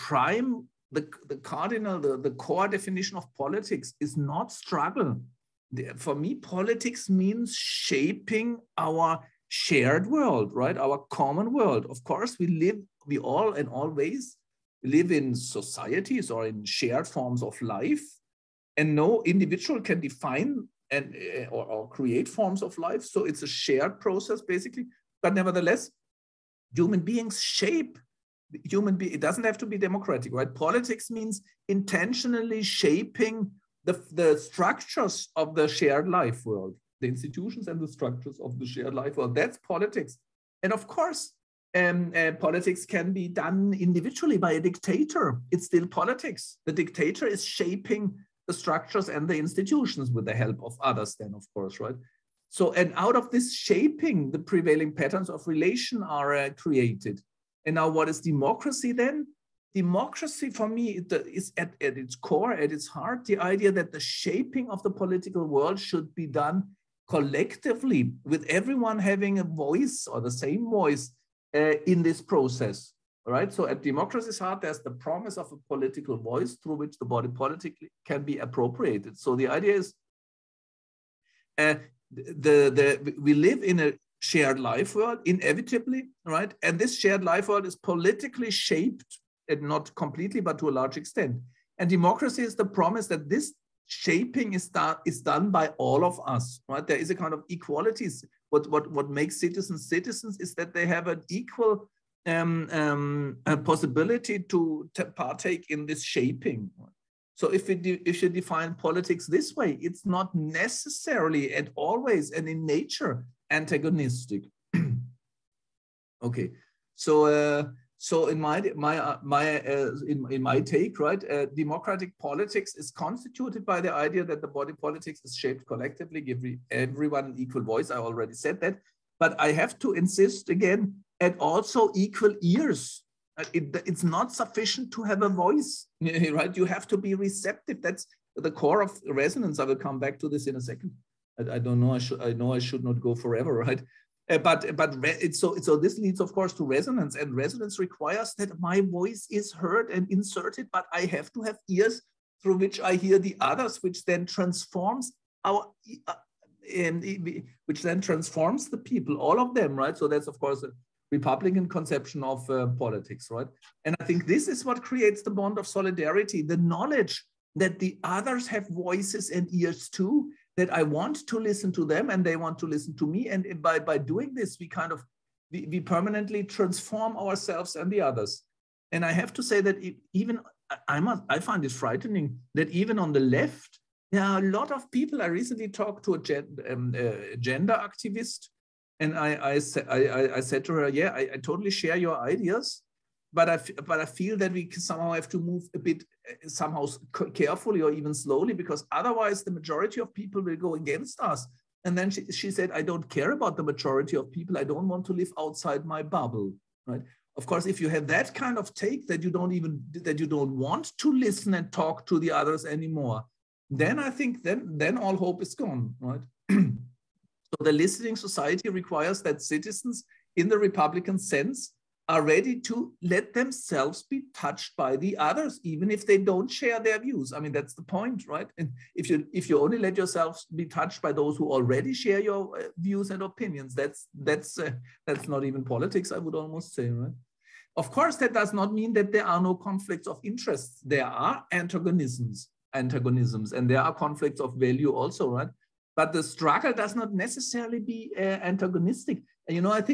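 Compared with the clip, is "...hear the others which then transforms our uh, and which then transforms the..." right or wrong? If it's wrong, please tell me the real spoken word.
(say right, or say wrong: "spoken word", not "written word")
right.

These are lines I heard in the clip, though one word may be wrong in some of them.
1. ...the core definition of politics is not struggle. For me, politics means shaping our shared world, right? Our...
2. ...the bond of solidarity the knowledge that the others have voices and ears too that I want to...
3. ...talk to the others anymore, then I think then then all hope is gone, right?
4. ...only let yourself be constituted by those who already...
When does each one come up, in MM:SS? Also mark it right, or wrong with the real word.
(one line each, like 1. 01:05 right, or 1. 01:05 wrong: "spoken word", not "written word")
1. 00:02 right
2. 02:45 right
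3. 03:31 right
4. 03:49 wrong: "touched", not "constituted".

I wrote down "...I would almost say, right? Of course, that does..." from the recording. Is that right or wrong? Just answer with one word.
right.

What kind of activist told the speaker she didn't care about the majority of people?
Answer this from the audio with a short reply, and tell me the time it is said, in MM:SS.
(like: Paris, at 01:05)
a gender activist, at 03:07.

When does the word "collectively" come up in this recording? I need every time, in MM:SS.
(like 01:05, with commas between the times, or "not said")
01:07, 02:05.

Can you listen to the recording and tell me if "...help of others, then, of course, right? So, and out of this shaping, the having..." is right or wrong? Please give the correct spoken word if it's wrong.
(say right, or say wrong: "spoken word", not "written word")
wrong: "prevailing", not "having".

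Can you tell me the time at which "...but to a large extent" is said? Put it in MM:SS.
01:30.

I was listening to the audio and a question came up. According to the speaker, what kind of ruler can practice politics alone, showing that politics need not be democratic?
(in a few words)
a dictator.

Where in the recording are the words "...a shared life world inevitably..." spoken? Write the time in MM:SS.
01:23.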